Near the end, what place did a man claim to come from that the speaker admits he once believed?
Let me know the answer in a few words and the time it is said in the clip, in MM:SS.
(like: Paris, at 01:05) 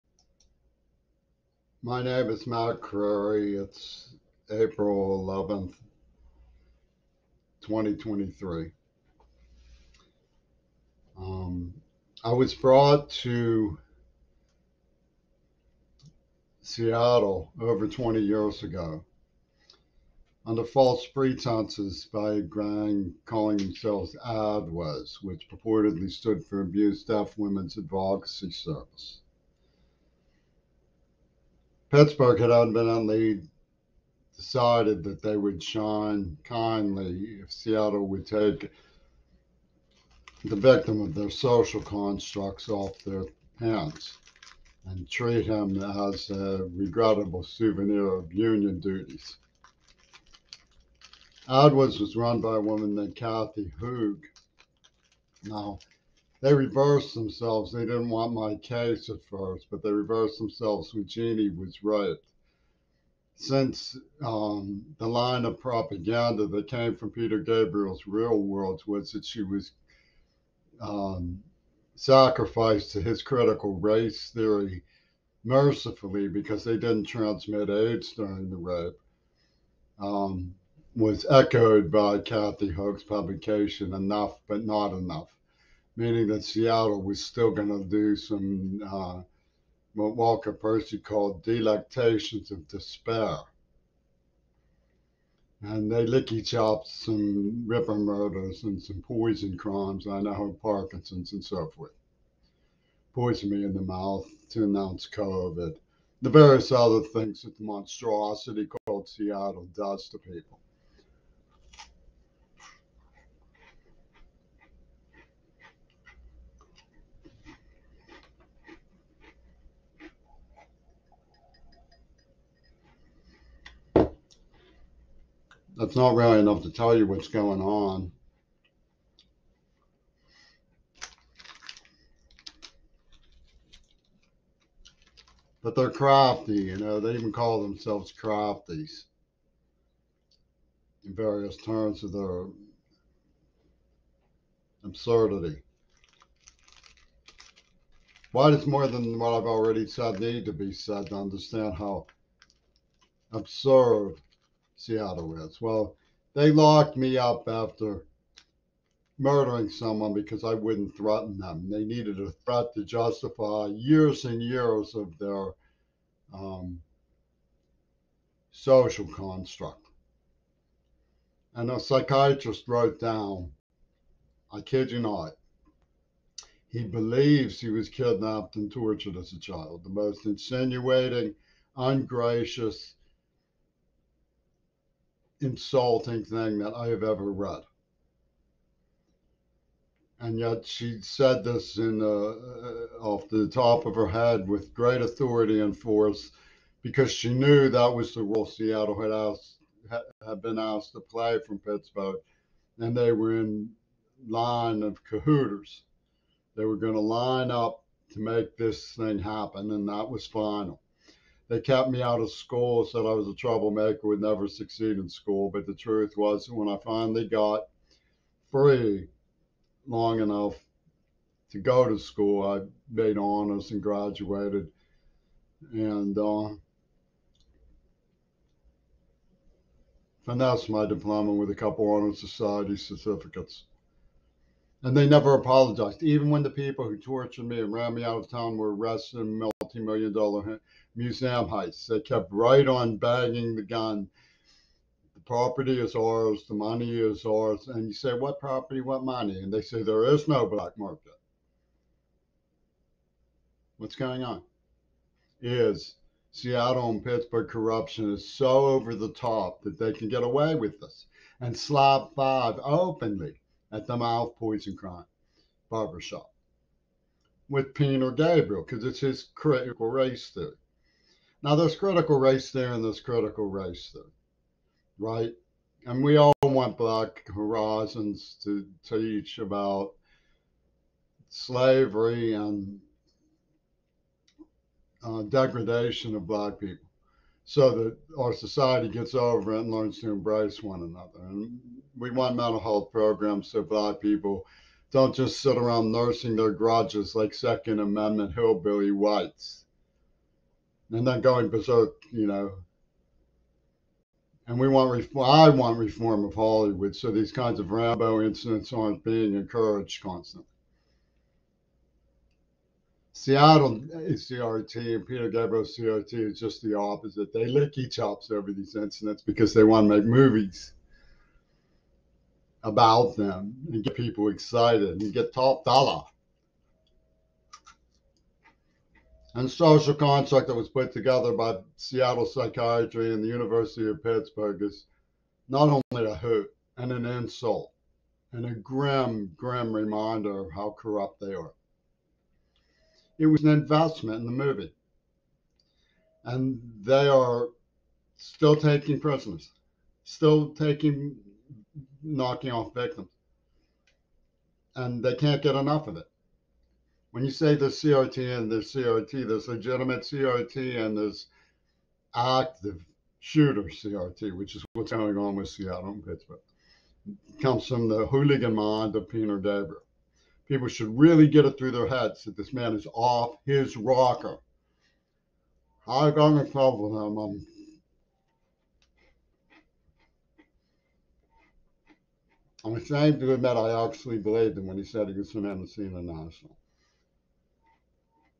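Mendocino National, at 06:25.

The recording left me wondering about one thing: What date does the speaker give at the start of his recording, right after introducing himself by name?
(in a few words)
April 11th, 2023.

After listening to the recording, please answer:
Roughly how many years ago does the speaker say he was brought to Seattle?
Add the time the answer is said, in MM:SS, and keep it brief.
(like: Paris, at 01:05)
Over 20 years, at 00:17.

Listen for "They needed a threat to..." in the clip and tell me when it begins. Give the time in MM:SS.
02:41.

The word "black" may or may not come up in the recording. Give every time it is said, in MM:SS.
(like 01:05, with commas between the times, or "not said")
04:10, 04:36, 04:46, 04:53.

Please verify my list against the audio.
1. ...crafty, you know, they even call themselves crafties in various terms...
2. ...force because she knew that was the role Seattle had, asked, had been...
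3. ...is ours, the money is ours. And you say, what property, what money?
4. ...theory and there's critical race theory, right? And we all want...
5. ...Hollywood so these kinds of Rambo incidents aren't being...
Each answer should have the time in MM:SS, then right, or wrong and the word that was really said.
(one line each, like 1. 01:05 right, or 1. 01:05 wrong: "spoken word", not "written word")
1. 02:15 right
2. 03:15 right
3. 04:05 right
4. 04:32 right
5. 05:06 right.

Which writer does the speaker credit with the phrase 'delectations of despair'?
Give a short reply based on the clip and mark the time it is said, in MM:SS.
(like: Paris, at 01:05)
Walker Percy, at 01:30.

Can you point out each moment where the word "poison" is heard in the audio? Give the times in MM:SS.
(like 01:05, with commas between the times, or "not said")
01:39, 01:43, 04:24.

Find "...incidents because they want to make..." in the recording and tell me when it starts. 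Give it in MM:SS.
05:18.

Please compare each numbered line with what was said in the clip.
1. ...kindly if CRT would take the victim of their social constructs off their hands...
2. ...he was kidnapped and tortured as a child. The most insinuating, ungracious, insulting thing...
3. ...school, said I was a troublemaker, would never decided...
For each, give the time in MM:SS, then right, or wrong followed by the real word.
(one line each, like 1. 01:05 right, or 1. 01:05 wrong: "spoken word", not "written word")
1. 00:36 wrong: "Seattle", not "CRT"
2. 02:57 right
3. 03:32 wrong: "succeed", not "decided".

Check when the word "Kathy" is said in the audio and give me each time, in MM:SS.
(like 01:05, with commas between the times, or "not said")
00:53, 01:22.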